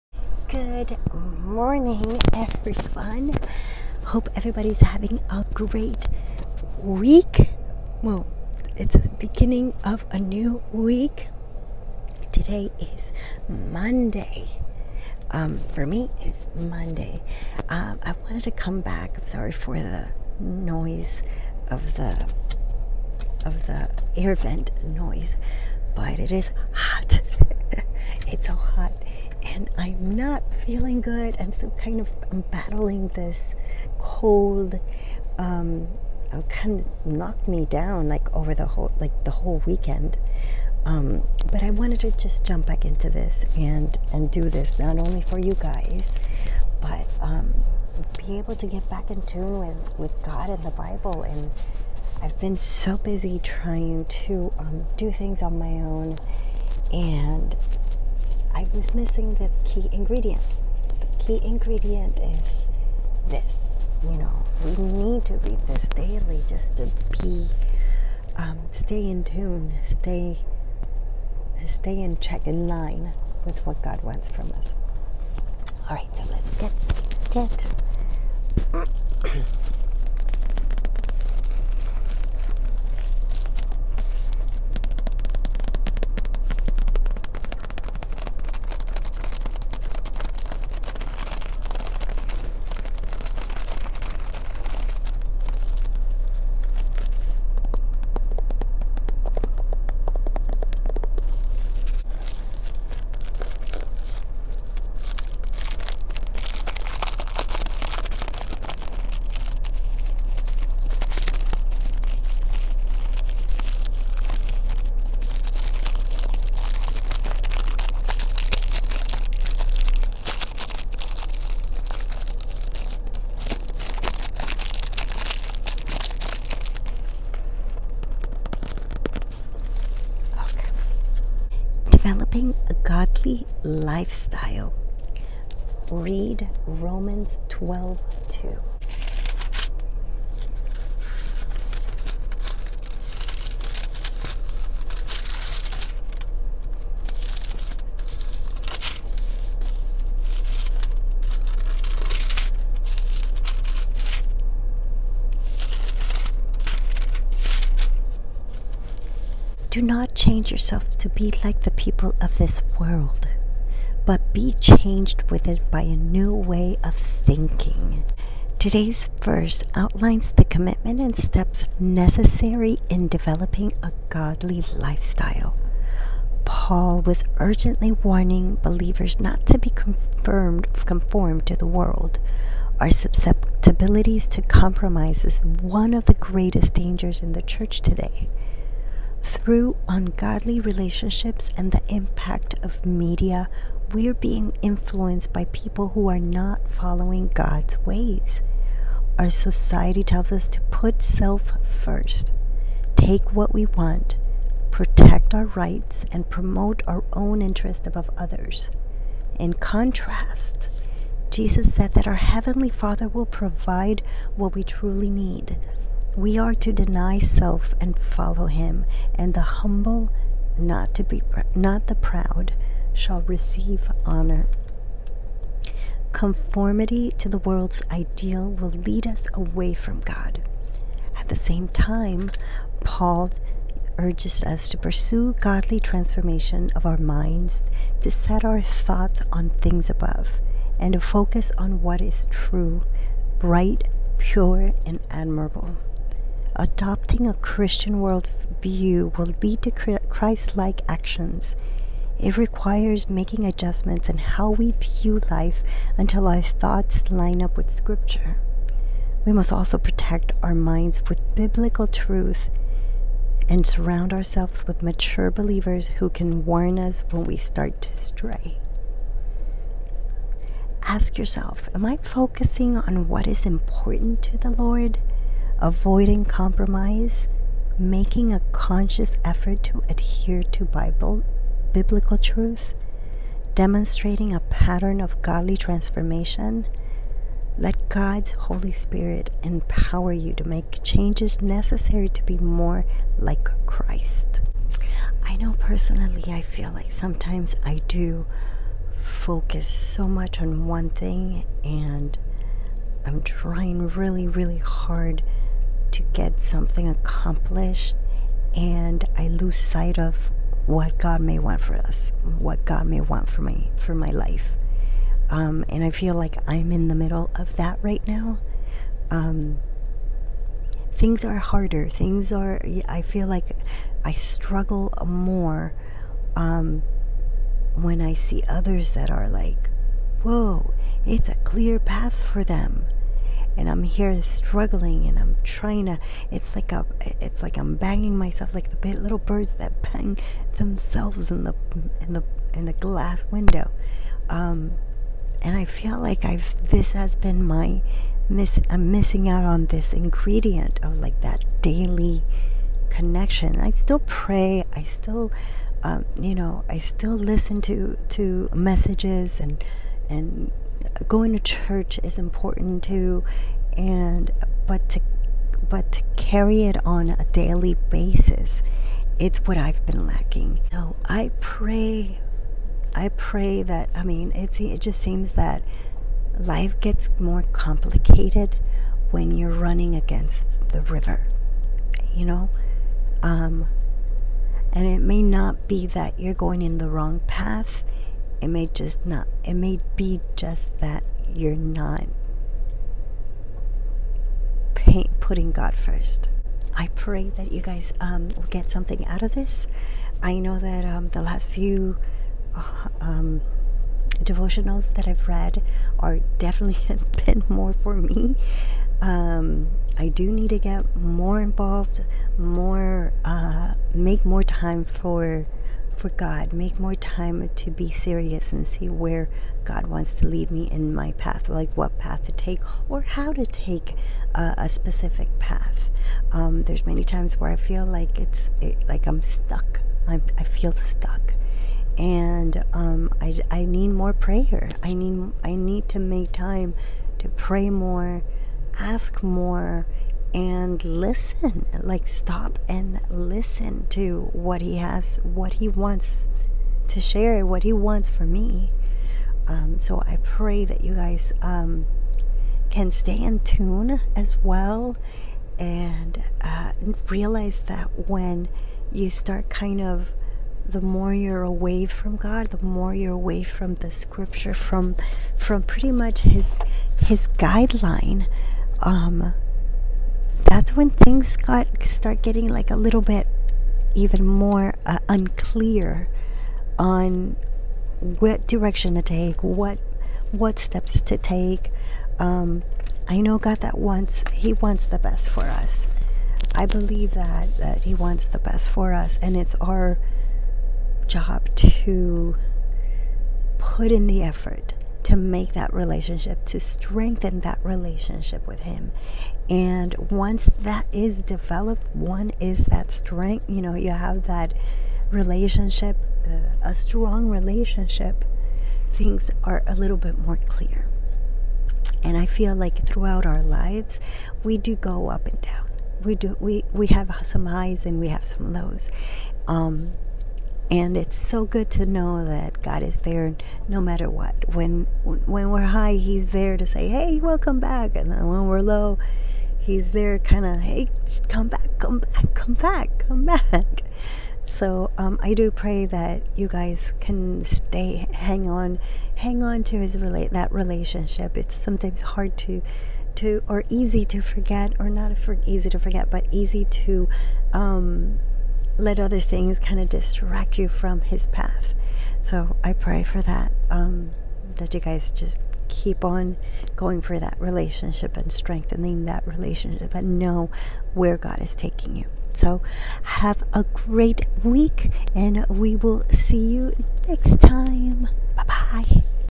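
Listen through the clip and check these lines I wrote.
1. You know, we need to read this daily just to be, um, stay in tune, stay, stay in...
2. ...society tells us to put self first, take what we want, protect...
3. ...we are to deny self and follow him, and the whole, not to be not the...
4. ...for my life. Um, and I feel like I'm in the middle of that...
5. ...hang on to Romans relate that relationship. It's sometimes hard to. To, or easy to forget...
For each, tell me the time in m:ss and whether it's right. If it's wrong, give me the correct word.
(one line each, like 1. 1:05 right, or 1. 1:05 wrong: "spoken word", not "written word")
1. 1:04 right
2. 3:19 right
3. 3:36 wrong: "humble", not "whole"
4. 5:13 right
5. 8:59 wrong: "His", not "Romans".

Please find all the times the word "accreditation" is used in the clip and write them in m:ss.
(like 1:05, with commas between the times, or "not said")
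not said.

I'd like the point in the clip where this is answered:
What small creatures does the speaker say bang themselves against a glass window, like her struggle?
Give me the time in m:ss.
5:38.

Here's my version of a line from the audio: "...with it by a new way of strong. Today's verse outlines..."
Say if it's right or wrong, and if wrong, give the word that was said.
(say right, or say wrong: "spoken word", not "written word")
wrong: "thinking", not "strong".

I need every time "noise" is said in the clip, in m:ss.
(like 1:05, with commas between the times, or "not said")
0:20, 0:24.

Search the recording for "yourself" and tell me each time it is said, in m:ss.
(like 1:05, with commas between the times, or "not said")
2:40, 4:31.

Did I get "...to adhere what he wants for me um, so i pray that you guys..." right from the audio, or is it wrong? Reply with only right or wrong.
wrong.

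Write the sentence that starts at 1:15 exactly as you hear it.
All right, so let's get started.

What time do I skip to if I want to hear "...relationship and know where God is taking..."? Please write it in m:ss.
9:19.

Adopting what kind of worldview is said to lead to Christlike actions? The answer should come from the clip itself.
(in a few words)
Christian worldview.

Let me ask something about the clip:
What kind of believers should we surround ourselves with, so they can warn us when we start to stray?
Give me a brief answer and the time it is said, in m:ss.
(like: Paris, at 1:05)
mature believers, at 4:24.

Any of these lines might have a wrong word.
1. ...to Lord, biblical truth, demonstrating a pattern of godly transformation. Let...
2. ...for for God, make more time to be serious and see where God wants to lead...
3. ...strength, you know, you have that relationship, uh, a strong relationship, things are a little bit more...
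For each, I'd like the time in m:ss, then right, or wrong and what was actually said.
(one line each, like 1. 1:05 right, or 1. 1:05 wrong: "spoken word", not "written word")
1. 4:40 wrong: "Bible", not "Lord"
2. 6:54 right
3. 8:22 right.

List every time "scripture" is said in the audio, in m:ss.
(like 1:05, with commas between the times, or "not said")
4:17, 7:43.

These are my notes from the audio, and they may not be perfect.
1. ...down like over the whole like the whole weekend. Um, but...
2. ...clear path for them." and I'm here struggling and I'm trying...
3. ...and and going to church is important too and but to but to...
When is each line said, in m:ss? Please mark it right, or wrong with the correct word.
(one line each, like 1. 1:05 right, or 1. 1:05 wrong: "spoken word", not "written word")
1. 0:37 right
2. 5:31 right
3. 5:59 right.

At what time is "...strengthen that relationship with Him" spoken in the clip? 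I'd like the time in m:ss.
8:16.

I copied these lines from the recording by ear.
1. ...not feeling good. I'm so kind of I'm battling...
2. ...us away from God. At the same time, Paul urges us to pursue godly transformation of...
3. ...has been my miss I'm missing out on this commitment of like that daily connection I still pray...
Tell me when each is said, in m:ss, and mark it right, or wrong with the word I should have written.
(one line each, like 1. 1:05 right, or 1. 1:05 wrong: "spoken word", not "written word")
1. 0:30 right
2. 3:49 right
3. 5:46 wrong: "ingredient", not "commitment".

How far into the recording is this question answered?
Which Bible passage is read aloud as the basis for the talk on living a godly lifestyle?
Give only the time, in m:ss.
2:16.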